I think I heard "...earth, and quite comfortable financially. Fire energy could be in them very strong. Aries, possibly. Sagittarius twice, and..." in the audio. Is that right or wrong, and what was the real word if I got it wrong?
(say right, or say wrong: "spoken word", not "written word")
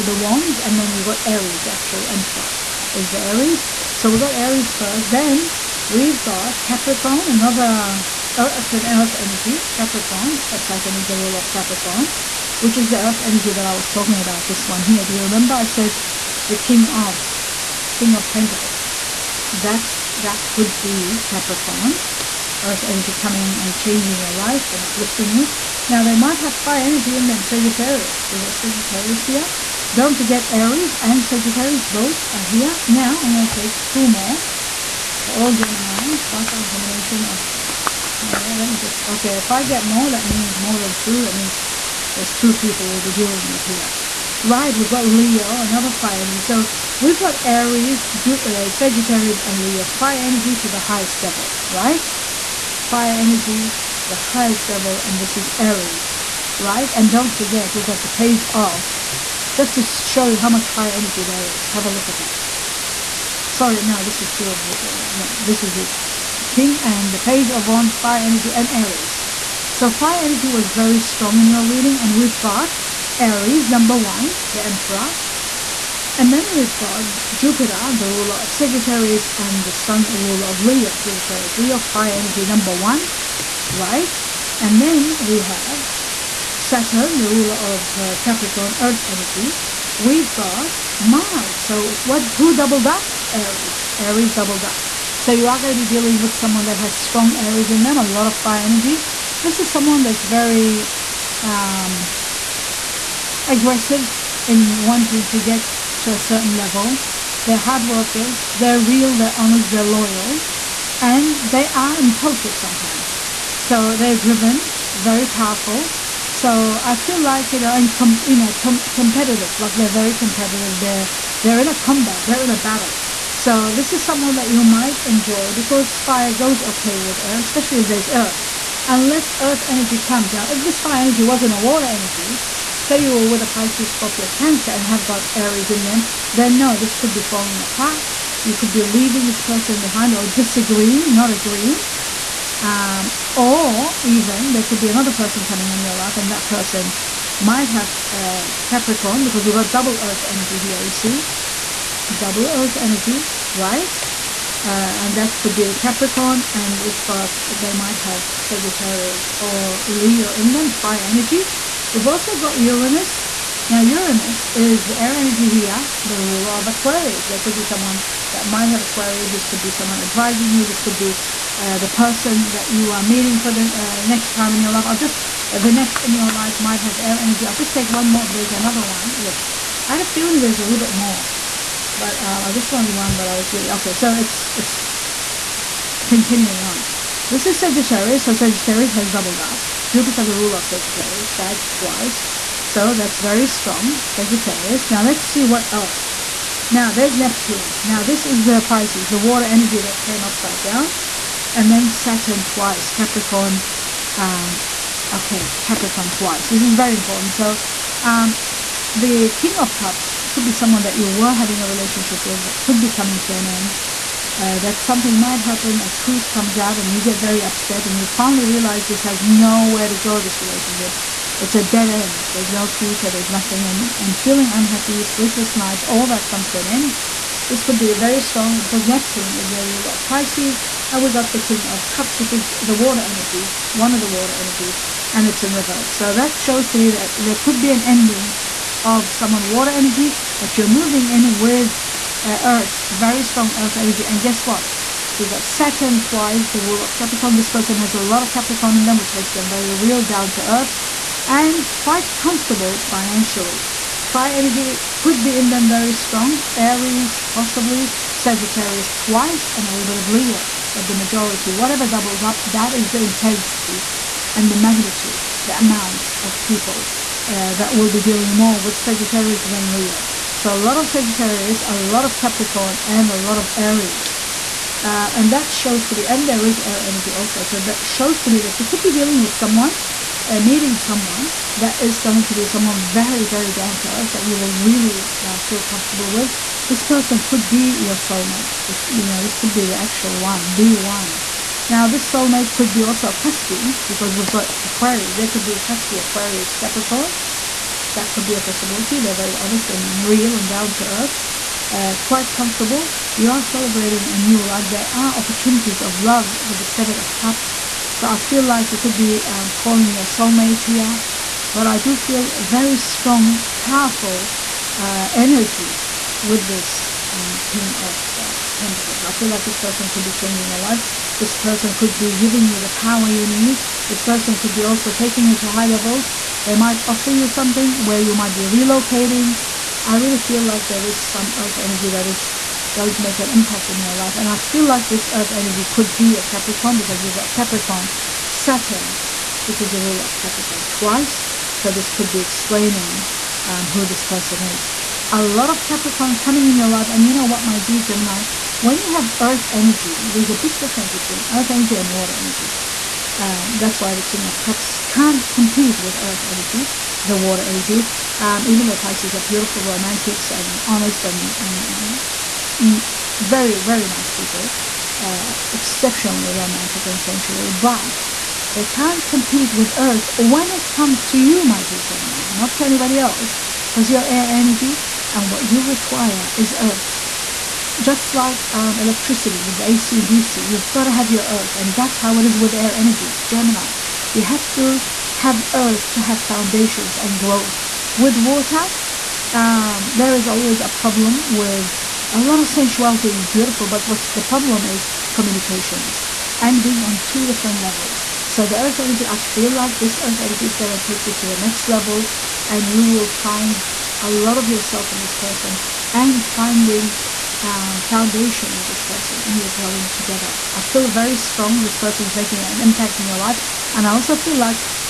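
right.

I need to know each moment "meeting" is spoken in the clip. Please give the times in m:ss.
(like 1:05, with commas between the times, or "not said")
2:53, 4:40.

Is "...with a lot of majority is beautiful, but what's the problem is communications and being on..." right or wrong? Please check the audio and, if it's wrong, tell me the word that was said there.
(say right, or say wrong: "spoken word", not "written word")
wrong: "sensuality", not "majority".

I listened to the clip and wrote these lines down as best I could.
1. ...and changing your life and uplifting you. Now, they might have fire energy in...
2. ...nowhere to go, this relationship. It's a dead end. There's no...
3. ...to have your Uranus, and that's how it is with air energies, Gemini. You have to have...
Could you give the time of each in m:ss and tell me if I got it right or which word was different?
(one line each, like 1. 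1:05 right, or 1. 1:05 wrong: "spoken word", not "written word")
1. 0:23 right
2. 3:39 right
3. 6:20 wrong: "Earth", not "Uranus".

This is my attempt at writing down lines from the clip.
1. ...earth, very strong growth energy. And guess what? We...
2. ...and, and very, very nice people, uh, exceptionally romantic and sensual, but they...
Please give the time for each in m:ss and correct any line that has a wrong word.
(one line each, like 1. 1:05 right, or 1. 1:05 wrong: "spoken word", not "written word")
1. 4:02 wrong: "earth", not "growth"
2. 6:01 right.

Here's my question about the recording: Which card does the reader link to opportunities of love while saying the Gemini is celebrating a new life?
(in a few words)
Seven of Cups.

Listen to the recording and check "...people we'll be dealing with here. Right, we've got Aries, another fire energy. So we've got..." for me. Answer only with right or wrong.
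wrong.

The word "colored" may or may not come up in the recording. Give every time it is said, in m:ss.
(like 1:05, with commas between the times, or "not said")
not said.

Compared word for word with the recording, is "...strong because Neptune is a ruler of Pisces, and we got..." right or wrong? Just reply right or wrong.
right.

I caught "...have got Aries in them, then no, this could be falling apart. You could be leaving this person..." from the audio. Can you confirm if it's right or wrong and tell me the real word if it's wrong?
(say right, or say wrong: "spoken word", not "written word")
right.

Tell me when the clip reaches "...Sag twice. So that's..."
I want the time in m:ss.
3:11.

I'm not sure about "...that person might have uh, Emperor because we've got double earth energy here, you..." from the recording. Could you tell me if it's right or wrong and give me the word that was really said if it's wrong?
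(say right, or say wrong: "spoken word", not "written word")
wrong: "Capricorn", not "Emperor".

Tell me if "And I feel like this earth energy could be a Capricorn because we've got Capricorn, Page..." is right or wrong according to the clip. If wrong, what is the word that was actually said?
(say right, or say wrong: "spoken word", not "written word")
wrong: "Saturn", not "Page".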